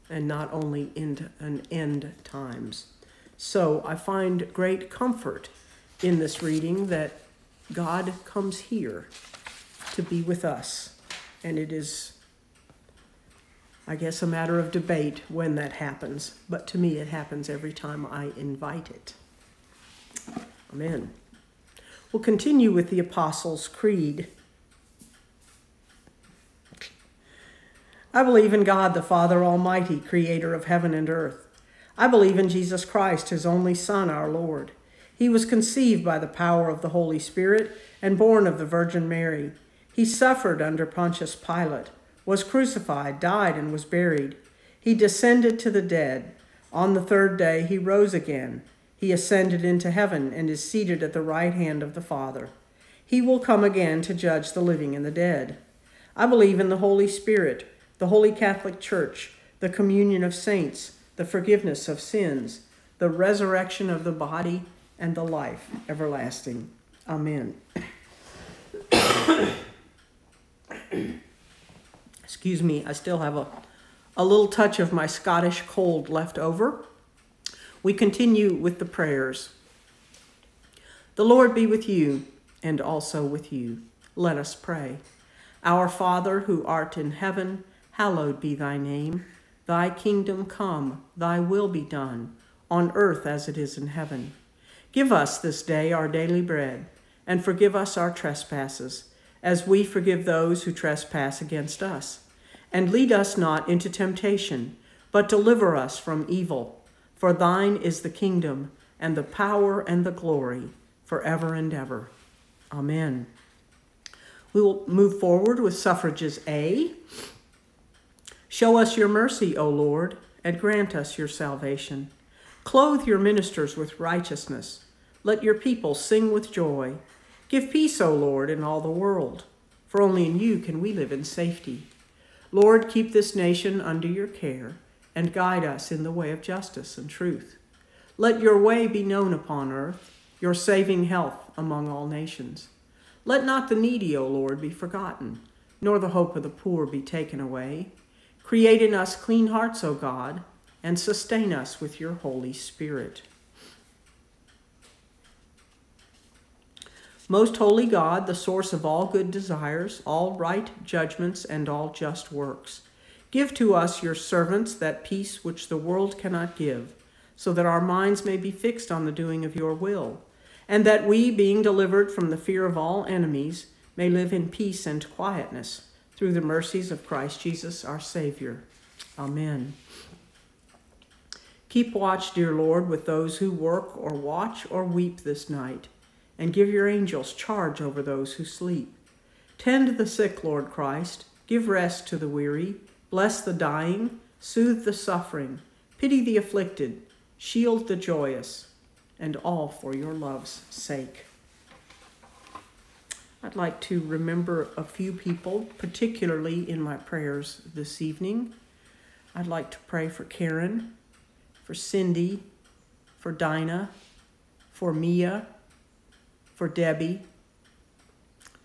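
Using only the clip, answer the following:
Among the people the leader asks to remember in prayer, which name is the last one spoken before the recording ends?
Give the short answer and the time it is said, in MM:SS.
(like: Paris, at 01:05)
Debbie, at 03:36.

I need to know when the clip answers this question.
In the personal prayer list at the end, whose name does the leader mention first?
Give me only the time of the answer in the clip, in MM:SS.
03:30.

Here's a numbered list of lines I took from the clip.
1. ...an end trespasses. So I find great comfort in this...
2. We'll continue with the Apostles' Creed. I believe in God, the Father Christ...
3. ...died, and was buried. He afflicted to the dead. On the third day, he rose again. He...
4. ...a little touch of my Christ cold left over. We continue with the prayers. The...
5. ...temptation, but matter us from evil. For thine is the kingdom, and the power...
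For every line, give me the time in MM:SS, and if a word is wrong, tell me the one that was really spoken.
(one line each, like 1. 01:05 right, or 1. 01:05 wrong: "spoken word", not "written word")
1. 00:01 wrong: "times", not "trespasses"
2. 00:22 wrong: "Almighty", not "Christ"
3. 00:43 wrong: "descended", not "afflicted"
4. 01:14 wrong: "Scottish", not "Christ"
5. 01:43 wrong: "deliver", not "matter".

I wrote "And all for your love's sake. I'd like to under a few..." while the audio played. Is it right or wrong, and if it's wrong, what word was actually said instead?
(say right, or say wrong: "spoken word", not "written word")
wrong: "remember", not "under".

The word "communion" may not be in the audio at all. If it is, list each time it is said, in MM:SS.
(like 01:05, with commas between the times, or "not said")
00:59.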